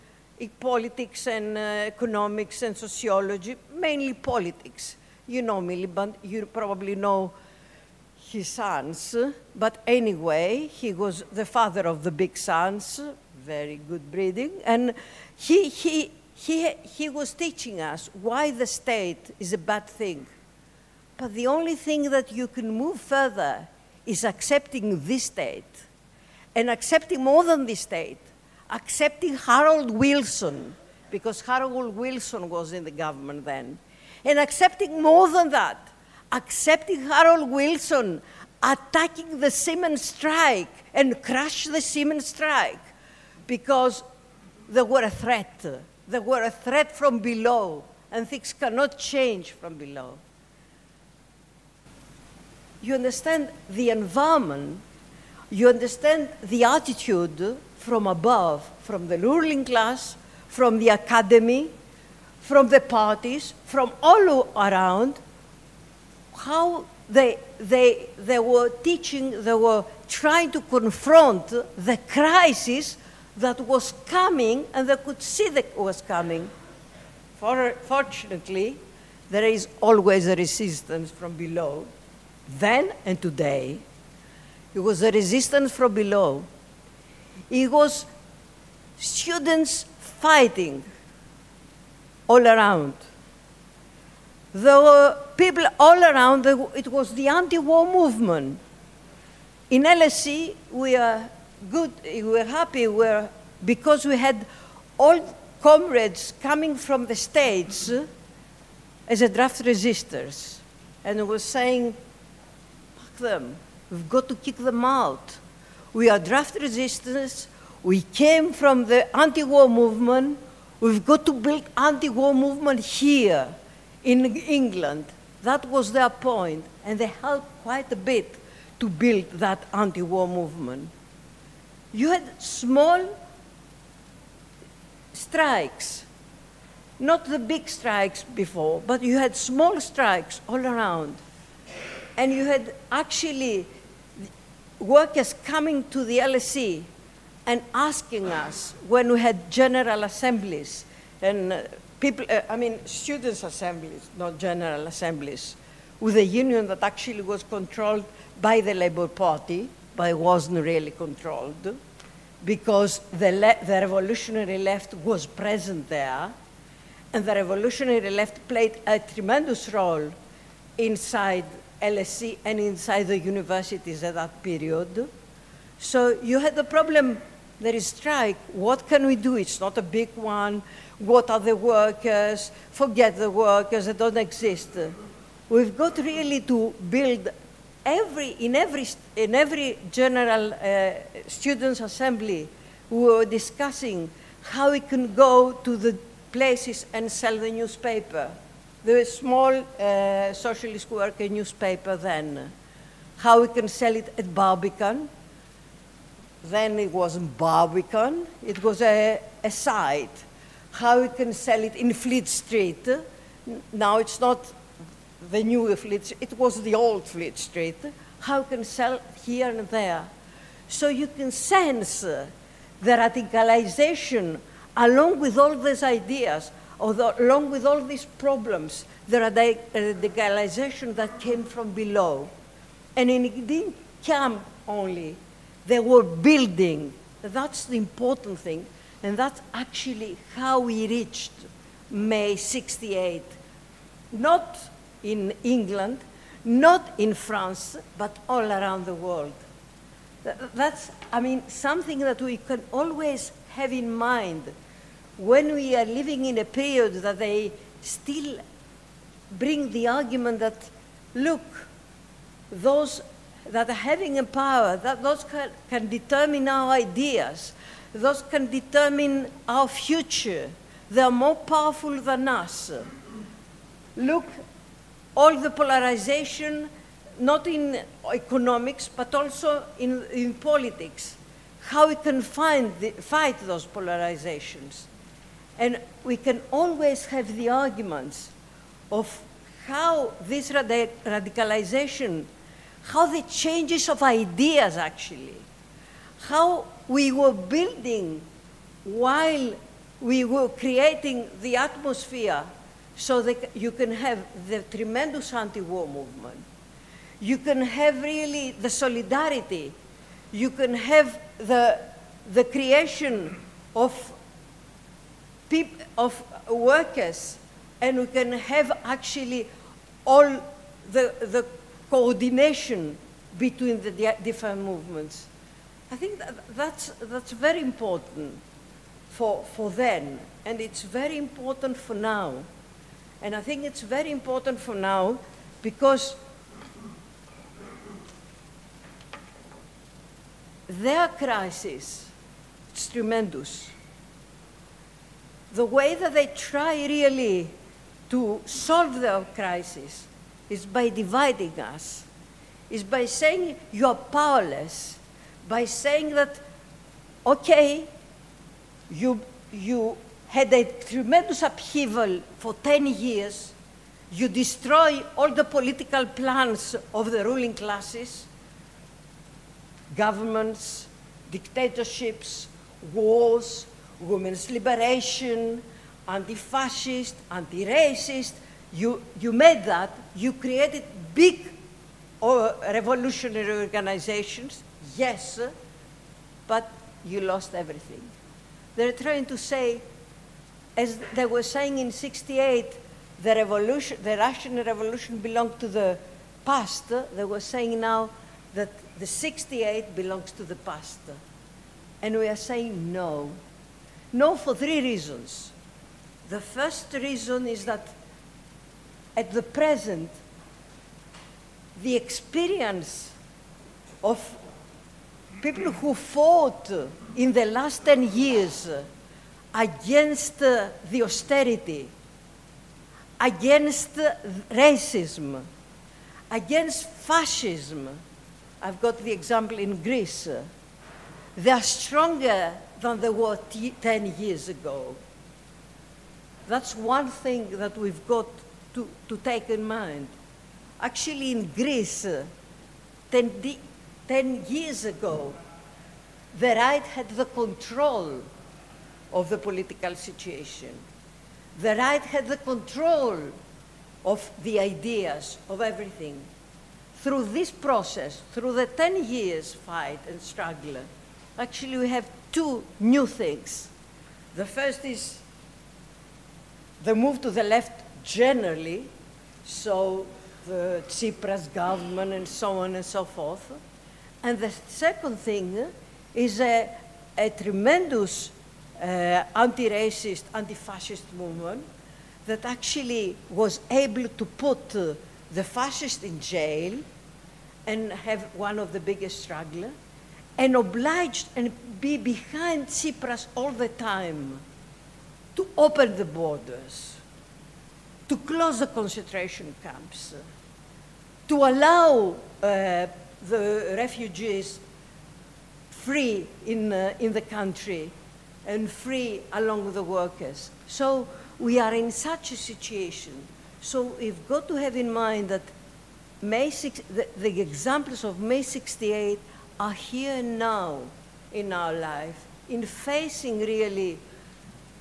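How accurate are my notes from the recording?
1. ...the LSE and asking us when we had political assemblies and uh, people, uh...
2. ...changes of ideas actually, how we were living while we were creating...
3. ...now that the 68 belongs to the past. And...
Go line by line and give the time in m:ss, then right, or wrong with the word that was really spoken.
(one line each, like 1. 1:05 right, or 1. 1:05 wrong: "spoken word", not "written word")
1. 2:26 wrong: "general", not "political"
2. 4:53 wrong: "building", not "living"
3. 6:37 right.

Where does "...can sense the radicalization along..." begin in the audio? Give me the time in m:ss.
3:41.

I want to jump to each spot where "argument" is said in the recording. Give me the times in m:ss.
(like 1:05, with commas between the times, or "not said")
4:19, 4:47.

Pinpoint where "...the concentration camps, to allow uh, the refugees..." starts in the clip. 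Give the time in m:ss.
8:18.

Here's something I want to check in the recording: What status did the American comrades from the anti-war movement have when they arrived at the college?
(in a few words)
draft resistors.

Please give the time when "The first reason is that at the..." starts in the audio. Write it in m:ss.
6:46.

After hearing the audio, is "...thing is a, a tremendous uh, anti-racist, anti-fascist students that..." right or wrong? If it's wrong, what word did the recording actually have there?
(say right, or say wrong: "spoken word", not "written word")
wrong: "movement", not "students".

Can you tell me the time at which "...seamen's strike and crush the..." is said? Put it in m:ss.
0:39.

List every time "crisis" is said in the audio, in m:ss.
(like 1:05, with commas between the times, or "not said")
1:12, 5:41, 5:49.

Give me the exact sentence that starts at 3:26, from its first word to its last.
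Then it wasn't Barbican, it was a, a site.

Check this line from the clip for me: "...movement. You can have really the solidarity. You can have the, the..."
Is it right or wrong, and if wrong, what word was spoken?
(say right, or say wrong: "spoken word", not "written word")
right.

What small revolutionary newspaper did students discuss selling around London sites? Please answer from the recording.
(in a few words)
Socialist Worker.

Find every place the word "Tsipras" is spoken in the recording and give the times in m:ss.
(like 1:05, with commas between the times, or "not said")
7:50, 8:12.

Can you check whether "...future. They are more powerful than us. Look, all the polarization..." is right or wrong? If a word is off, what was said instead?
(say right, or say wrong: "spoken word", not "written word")
right.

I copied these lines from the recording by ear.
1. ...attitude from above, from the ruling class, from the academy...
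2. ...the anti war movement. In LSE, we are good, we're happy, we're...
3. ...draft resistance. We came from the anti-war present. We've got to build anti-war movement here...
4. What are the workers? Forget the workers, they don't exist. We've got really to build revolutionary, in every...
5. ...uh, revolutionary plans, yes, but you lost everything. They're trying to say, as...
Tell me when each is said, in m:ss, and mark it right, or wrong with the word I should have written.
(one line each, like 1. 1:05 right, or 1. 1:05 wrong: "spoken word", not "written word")
1. 0:56 right
2. 1:37 right
3. 1:56 wrong: "movement", not "present"
4. 3:00 wrong: "every", not "revolutionary"
5. 6:22 wrong: "organizations", not "plans".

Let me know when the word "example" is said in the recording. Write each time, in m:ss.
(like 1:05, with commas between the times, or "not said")
7:09, 8:37.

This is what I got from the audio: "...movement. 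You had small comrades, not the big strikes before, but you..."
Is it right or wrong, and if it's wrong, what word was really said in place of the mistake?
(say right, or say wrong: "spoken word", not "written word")
wrong: "strikes", not "comrades".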